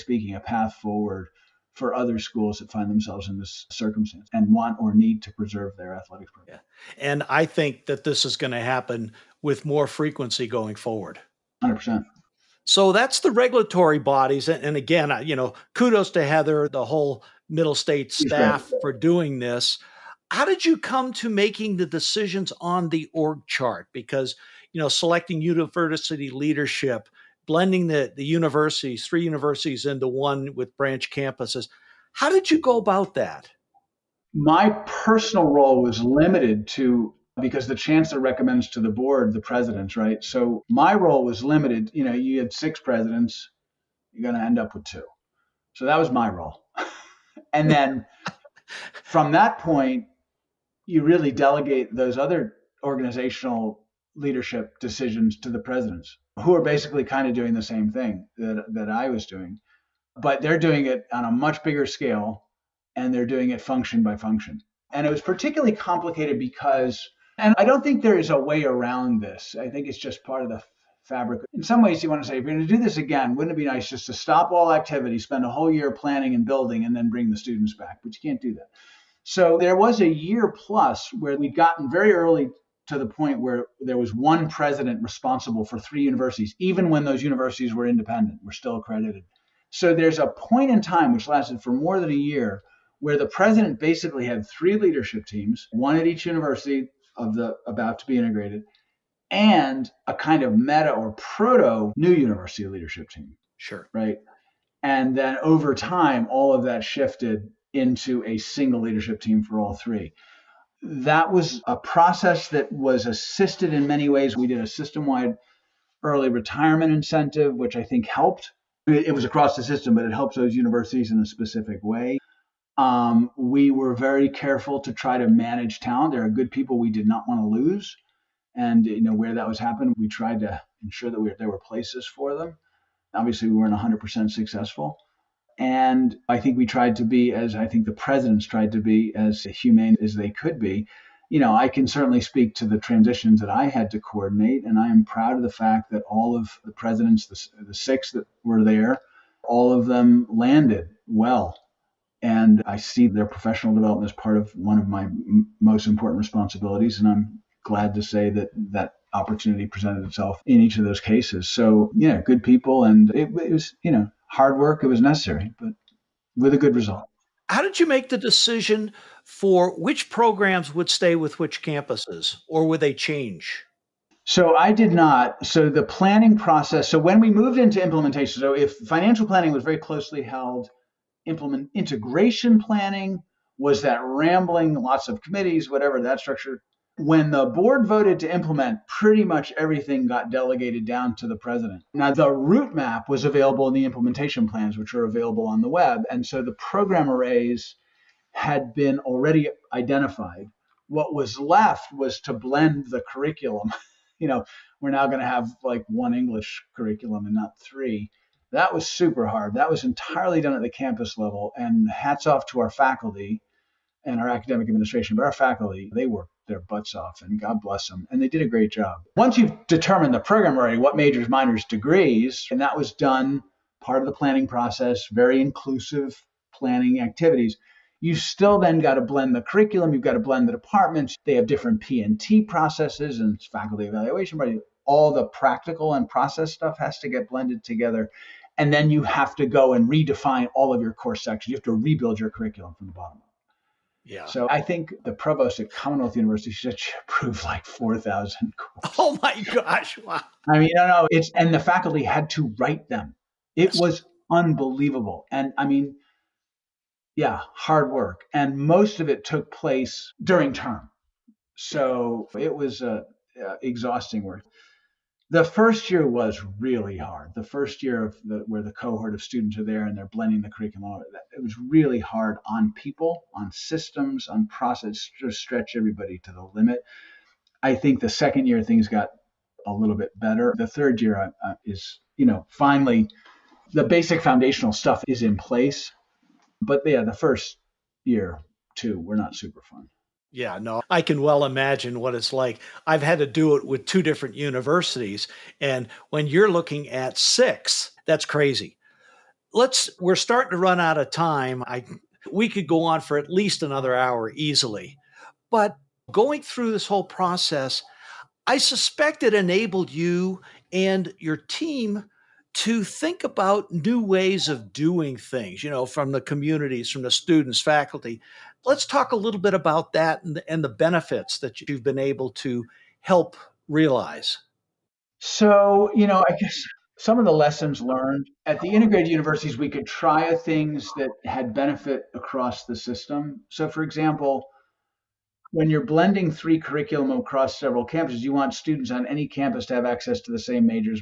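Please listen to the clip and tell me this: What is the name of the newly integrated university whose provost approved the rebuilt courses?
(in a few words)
Commonwealth University.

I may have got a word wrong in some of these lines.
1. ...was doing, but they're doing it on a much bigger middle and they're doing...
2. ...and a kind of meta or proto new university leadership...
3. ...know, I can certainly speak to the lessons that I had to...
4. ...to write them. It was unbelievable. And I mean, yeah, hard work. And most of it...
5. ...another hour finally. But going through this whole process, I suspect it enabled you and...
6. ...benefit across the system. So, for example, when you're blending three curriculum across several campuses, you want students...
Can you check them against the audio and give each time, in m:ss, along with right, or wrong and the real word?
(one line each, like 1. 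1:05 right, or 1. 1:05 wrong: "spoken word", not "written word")
1. 0:59 wrong: "scale", not "middle"
2. 1:39 right
3. 2:21 wrong: "transitions", not "lessons"
4. 4:12 right
5. 5:03 wrong: "easily", not "finally"
6. 5:31 right.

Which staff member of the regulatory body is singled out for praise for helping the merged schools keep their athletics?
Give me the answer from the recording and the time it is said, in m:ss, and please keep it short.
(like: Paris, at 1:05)
Heather, at 0:16.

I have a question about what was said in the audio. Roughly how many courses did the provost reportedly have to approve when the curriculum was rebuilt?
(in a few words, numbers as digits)
4,000.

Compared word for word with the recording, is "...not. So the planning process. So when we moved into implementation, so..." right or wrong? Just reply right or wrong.
right.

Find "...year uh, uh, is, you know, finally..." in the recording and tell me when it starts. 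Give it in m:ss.
4:41.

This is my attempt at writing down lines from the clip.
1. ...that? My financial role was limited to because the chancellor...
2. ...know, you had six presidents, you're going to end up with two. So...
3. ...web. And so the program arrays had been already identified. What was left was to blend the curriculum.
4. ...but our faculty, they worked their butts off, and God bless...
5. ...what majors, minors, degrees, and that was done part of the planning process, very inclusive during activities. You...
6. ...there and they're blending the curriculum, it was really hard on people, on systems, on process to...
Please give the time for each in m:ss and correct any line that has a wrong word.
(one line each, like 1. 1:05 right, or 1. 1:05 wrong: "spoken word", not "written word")
1. 0:33 wrong: "personal", not "financial"
2. 0:42 right
3. 3:15 right
4. 3:35 right
5. 3:40 wrong: "planning", not "during"
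6. 4:29 right.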